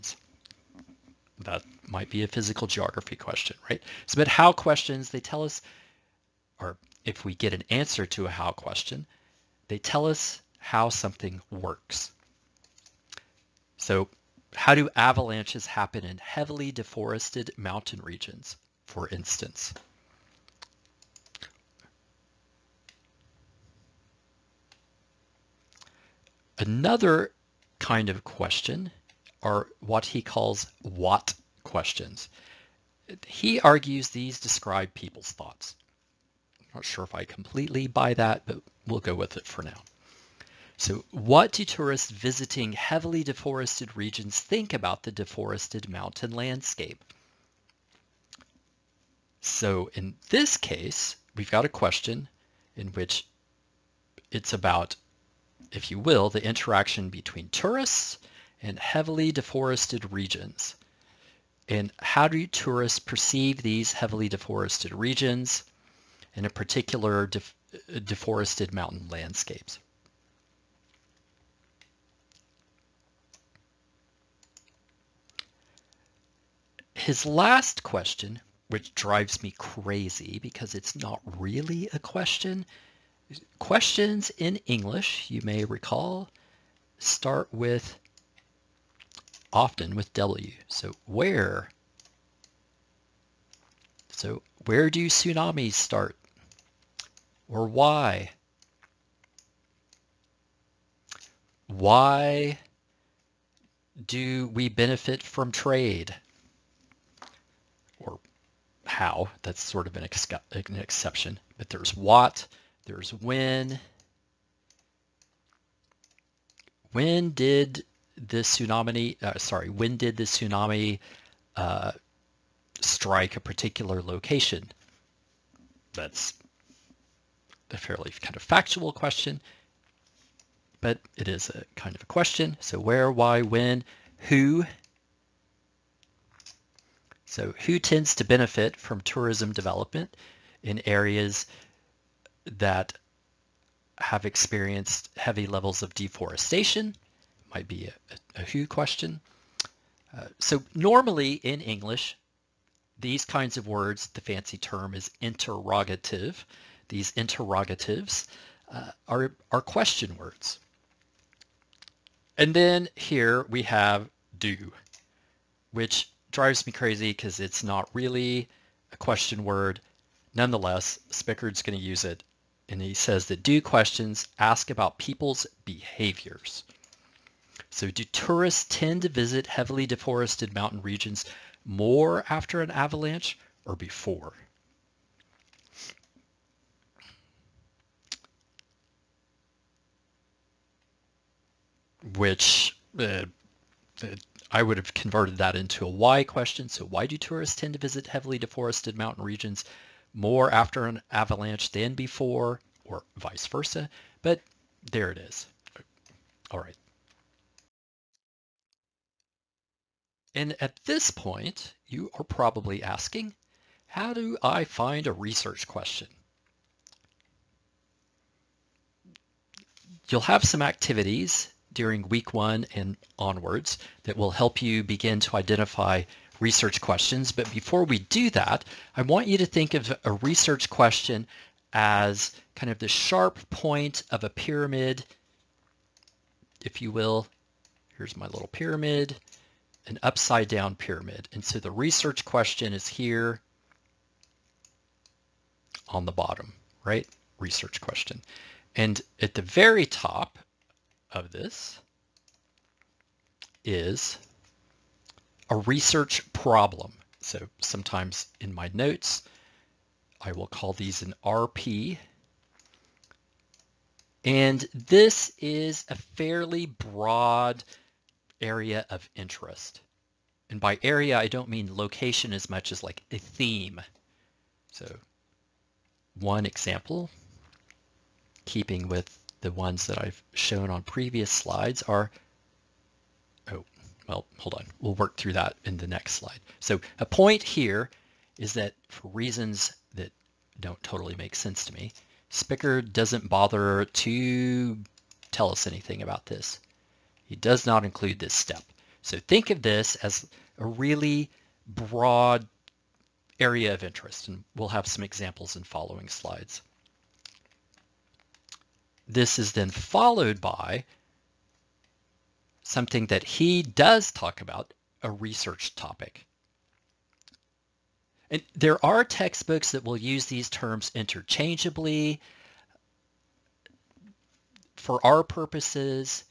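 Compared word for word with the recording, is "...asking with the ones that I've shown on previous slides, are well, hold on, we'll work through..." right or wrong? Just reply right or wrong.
wrong.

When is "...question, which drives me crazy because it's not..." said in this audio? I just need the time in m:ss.
1:17.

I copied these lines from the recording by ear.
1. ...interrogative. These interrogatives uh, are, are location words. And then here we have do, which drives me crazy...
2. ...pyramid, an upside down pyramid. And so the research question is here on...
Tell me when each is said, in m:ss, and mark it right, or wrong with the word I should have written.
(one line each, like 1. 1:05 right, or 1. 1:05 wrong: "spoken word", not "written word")
1. 2:35 wrong: "question", not "location"
2. 3:58 right.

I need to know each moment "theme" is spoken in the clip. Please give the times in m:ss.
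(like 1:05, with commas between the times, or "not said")
4:33.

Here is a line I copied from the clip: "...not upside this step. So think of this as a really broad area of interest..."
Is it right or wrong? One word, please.
wrong.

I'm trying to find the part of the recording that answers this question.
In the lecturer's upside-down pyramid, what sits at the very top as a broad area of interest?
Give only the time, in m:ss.
4:15.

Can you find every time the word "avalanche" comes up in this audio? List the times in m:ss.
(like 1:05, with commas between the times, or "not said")
0:14, 3:02, 3:21.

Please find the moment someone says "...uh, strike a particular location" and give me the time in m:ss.
2:01.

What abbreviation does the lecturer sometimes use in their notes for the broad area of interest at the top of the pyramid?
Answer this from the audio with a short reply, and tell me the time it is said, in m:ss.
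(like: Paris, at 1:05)
RP, at 4:21.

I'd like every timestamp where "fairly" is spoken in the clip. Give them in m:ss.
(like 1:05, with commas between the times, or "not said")
2:07, 4:25.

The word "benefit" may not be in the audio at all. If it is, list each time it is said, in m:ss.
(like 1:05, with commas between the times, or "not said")
1:44, 2:18.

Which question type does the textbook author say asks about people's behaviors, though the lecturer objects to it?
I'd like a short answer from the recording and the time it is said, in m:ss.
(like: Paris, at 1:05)
Do questions, at 2:53.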